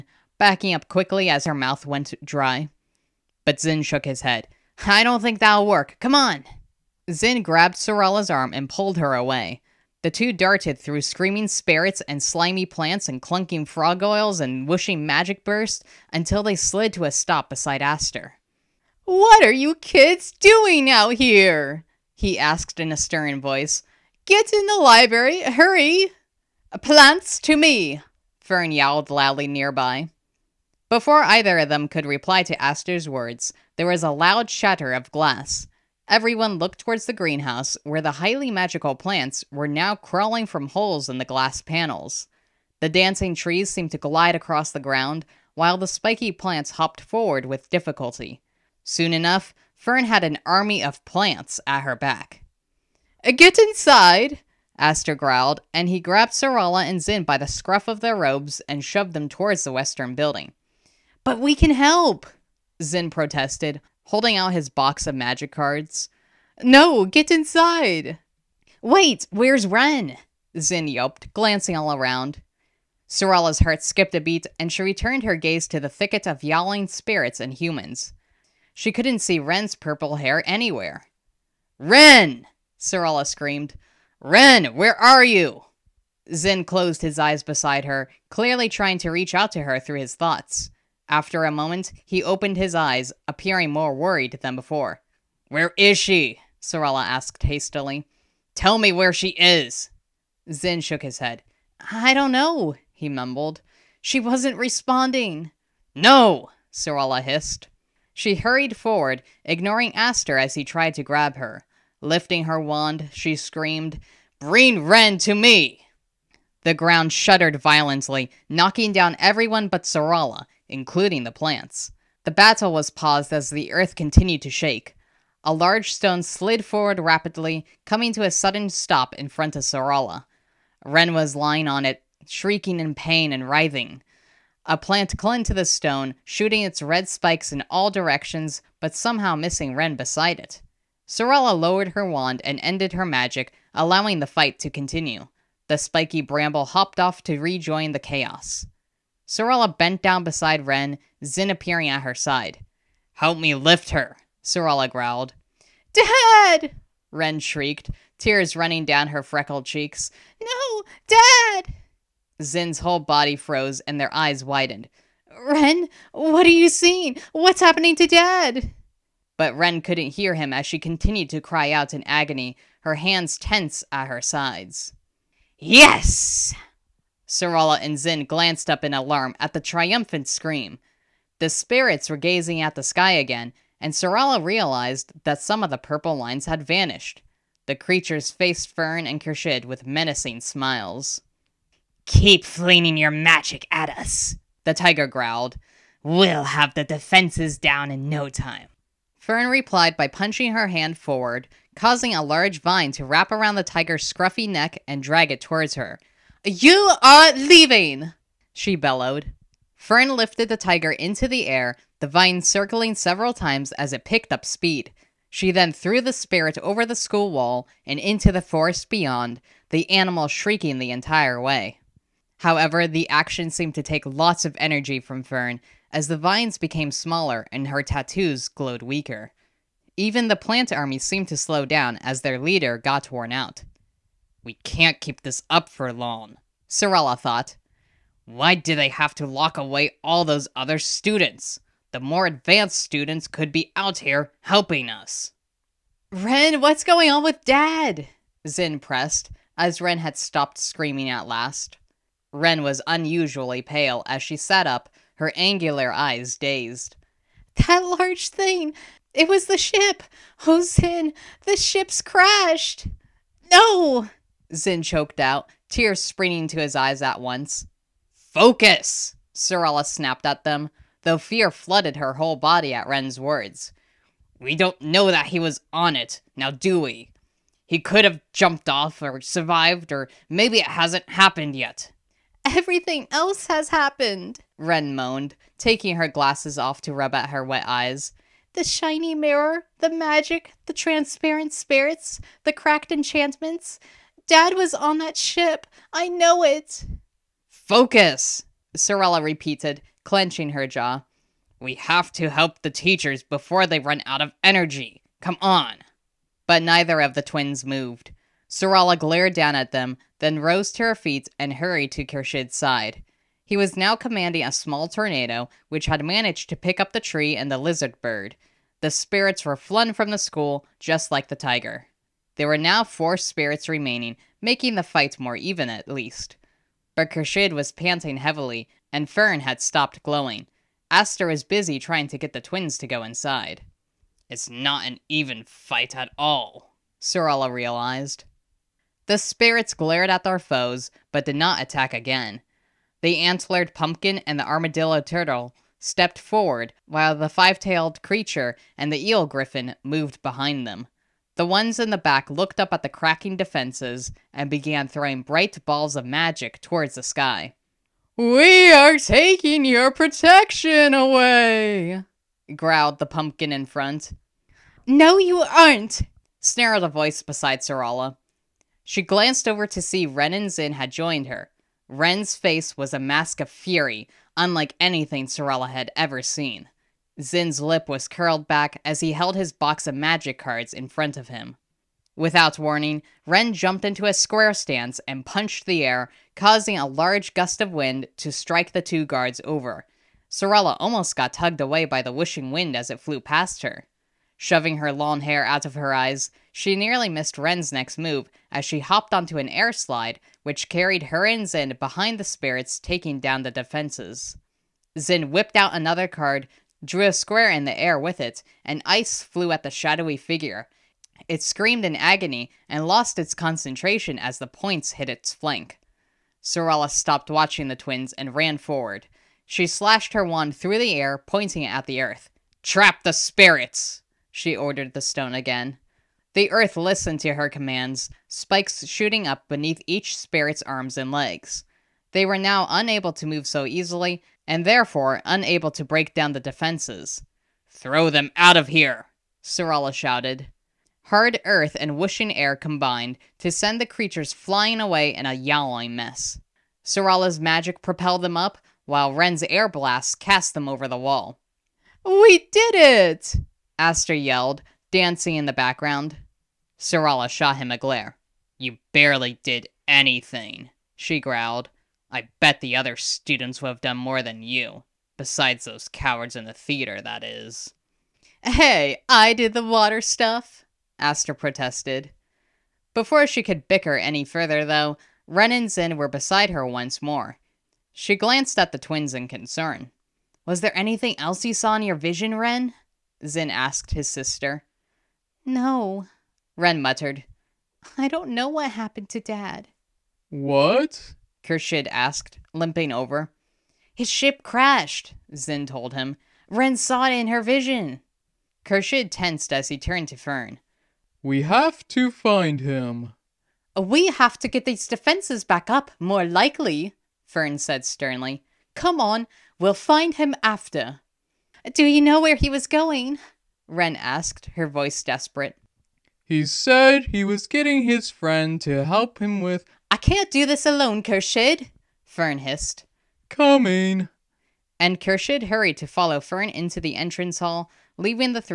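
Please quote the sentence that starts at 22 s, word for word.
he asked in a stern voice.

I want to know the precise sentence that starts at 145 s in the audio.
The spiky bramble hopped off to rejoin the chaos.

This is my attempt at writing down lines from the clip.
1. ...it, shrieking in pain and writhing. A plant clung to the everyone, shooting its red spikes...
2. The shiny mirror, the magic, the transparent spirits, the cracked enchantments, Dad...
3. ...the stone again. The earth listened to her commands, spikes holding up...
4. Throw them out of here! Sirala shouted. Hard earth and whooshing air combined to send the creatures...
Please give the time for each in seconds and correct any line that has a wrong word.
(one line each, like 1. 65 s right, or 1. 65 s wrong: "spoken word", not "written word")
1. 131 s wrong: "stone", not "everyone"
2. 288 s right
3. 424 s wrong: "shooting", not "holding"
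4. 437 s right.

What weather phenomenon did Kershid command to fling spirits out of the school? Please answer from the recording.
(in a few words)
Tornado.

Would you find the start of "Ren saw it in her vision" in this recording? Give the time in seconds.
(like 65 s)
496 s.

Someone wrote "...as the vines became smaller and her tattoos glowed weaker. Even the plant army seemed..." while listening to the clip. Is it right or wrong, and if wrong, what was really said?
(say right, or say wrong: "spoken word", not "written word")
right.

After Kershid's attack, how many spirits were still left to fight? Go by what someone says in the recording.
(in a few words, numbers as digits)
4.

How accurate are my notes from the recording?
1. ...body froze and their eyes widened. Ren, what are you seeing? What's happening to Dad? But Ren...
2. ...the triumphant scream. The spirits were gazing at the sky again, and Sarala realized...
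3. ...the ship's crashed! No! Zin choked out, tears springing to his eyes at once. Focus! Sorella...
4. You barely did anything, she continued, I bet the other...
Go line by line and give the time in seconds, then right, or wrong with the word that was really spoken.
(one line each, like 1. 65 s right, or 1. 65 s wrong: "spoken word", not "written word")
1. 163 s right
2. 179 s right
3. 261 s right
4. 458 s wrong: "growled", not "continued".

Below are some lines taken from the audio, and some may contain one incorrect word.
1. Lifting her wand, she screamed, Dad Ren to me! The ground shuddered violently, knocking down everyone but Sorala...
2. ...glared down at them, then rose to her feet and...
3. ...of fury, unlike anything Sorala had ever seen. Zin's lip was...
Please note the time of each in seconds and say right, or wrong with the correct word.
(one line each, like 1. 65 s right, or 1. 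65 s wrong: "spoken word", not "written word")
1. 112 s wrong: "Bring", not "Dad"
2. 308 s right
3. 373 s right.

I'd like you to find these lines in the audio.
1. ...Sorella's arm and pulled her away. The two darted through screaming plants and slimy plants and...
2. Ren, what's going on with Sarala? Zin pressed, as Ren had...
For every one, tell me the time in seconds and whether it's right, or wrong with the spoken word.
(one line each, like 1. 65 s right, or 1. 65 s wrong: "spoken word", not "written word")
1. 7 s wrong: "spirits", not "plants"
2. 246 s wrong: "Dad", not "Sarala".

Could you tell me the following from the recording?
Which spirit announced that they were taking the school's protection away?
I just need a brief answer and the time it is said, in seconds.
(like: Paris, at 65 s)
The antlered pumpkin, at 362 s.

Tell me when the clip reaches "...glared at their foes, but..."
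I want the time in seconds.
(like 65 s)
339 s.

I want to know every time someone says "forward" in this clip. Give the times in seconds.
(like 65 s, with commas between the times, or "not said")
47 s, 108 s, 126 s, 200 s, 346 s, 418 s.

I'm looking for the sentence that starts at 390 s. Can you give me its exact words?
Sorella almost got tugged away by the wishing wind as it flew past her.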